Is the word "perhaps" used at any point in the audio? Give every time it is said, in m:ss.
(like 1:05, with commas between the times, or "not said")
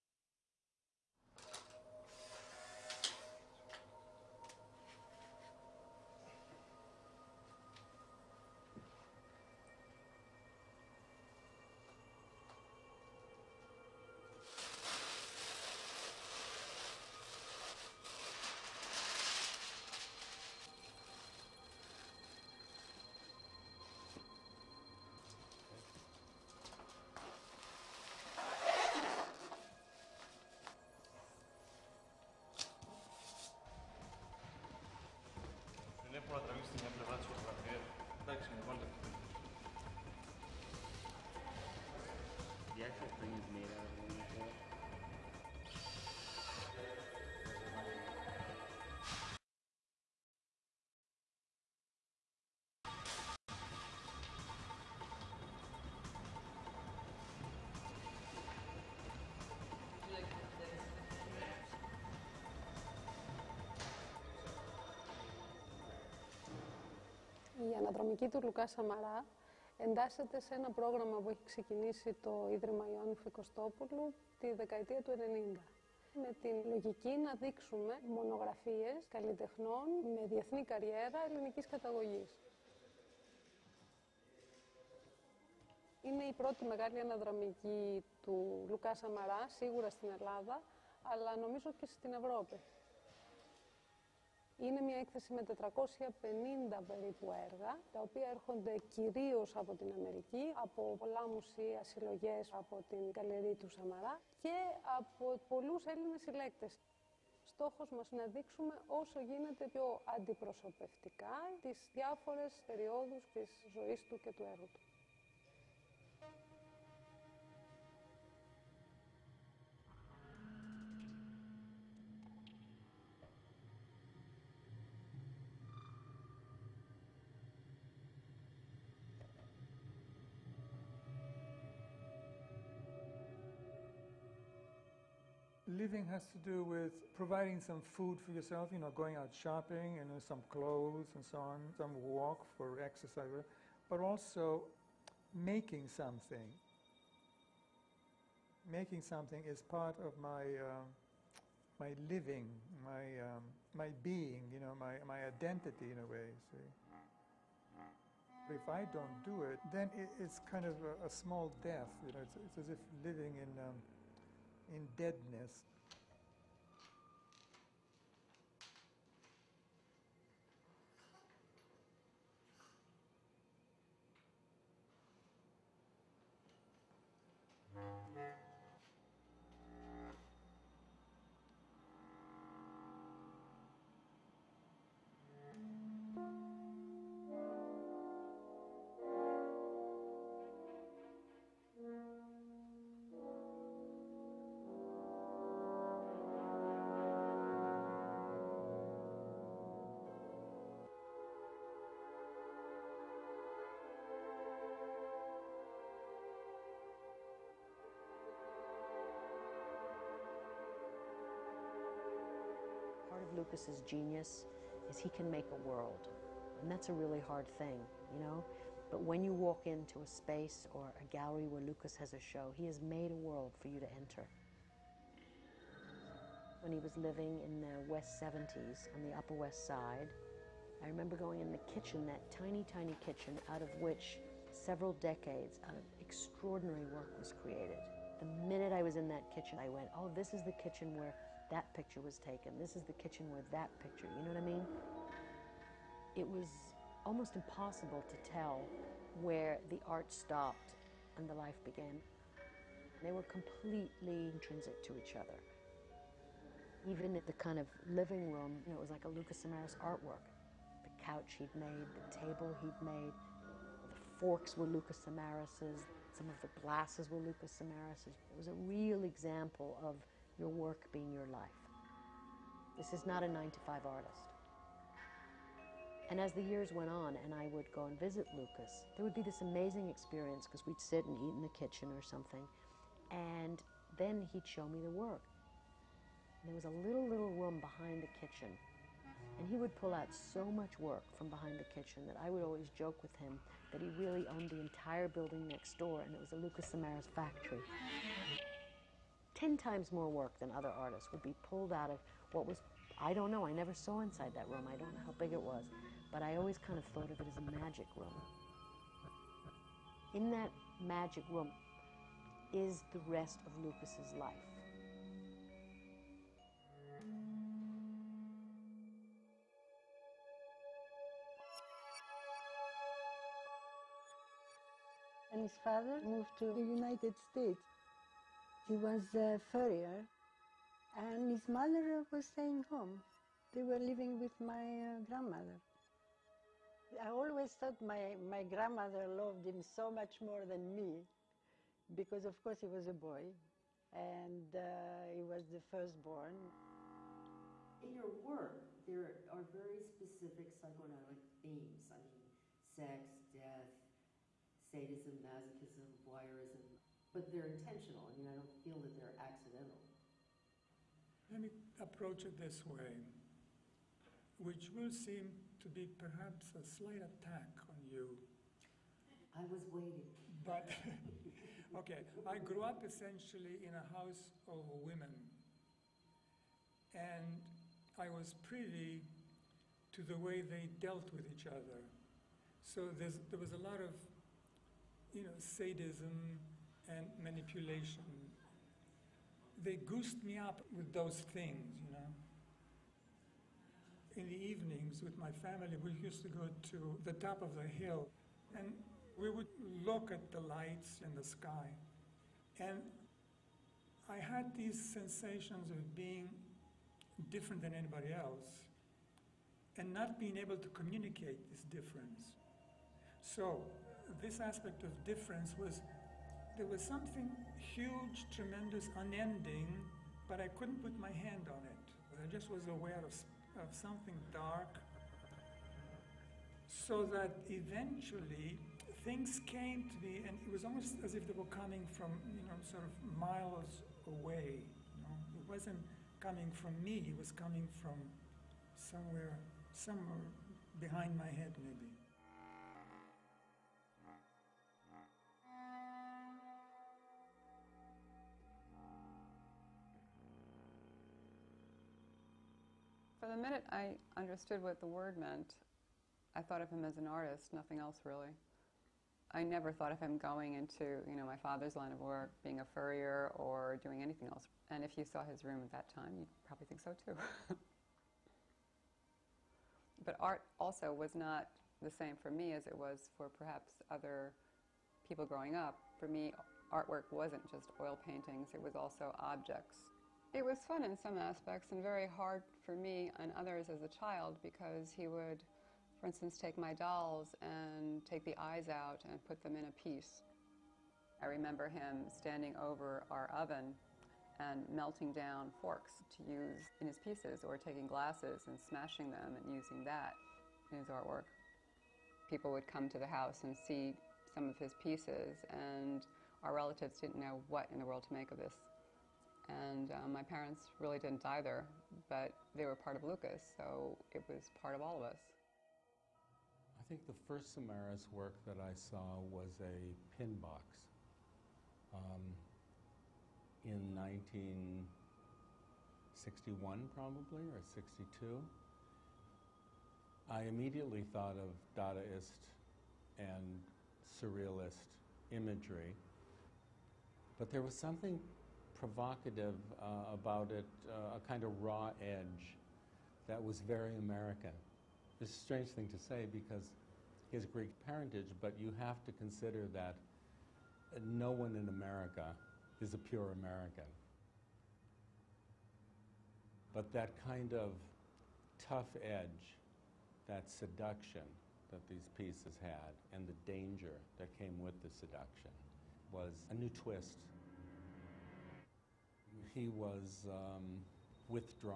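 6:05, 7:53.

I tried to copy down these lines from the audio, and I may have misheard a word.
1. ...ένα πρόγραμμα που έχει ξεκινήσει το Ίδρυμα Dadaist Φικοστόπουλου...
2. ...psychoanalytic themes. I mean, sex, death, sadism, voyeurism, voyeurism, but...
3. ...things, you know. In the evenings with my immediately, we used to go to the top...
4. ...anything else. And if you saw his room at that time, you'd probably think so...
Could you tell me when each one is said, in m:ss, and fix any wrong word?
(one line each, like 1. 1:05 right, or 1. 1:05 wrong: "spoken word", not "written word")
1. 1:10 wrong: "Ιωάννη", not "Dadaist"
2. 5:50 wrong: "masochism", not "voyeurism"
3. 6:31 wrong: "family", not "immediately"
4. 7:44 right.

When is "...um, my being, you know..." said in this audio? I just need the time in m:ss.
2:33.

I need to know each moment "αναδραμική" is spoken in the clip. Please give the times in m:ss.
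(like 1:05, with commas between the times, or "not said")
1:27.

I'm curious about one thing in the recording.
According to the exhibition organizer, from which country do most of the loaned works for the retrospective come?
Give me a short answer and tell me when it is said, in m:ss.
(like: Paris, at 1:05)
America, at 1:39.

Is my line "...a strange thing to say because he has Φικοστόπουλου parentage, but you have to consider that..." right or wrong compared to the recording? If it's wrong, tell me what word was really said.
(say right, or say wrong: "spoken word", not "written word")
wrong: "Greek", not "Φικοστόπουλου".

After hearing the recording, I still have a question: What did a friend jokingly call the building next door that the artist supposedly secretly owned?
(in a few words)
Lucas Samaras factory.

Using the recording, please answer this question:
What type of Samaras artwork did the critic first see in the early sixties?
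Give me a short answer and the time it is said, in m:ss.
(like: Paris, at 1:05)
Pin box, at 8:40.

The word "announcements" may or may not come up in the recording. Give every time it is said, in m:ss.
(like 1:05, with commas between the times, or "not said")
not said.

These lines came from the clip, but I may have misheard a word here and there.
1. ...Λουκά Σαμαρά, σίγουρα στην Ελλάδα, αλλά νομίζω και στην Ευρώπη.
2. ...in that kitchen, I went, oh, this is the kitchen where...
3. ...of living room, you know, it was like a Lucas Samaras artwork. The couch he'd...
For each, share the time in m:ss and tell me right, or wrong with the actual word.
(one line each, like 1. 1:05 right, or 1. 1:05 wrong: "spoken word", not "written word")
1. 1:28 right
2. 3:58 right
3. 4:17 right.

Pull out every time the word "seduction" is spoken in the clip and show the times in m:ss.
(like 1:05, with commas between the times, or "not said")
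9:20, 9:24.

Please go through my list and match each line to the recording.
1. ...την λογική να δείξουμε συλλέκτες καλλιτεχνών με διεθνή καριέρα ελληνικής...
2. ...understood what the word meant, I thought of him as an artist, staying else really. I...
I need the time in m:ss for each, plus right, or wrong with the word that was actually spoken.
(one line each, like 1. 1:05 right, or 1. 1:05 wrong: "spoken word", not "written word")
1. 1:16 wrong: "μονογραφίες", not "συλλέκτες"
2. 7:34 wrong: "nothing", not "staying".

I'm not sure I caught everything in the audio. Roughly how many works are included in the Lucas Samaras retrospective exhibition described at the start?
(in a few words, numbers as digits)
450.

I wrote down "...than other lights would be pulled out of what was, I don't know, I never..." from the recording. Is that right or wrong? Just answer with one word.
wrong.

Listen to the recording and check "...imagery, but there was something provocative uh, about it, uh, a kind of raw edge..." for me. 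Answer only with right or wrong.
right.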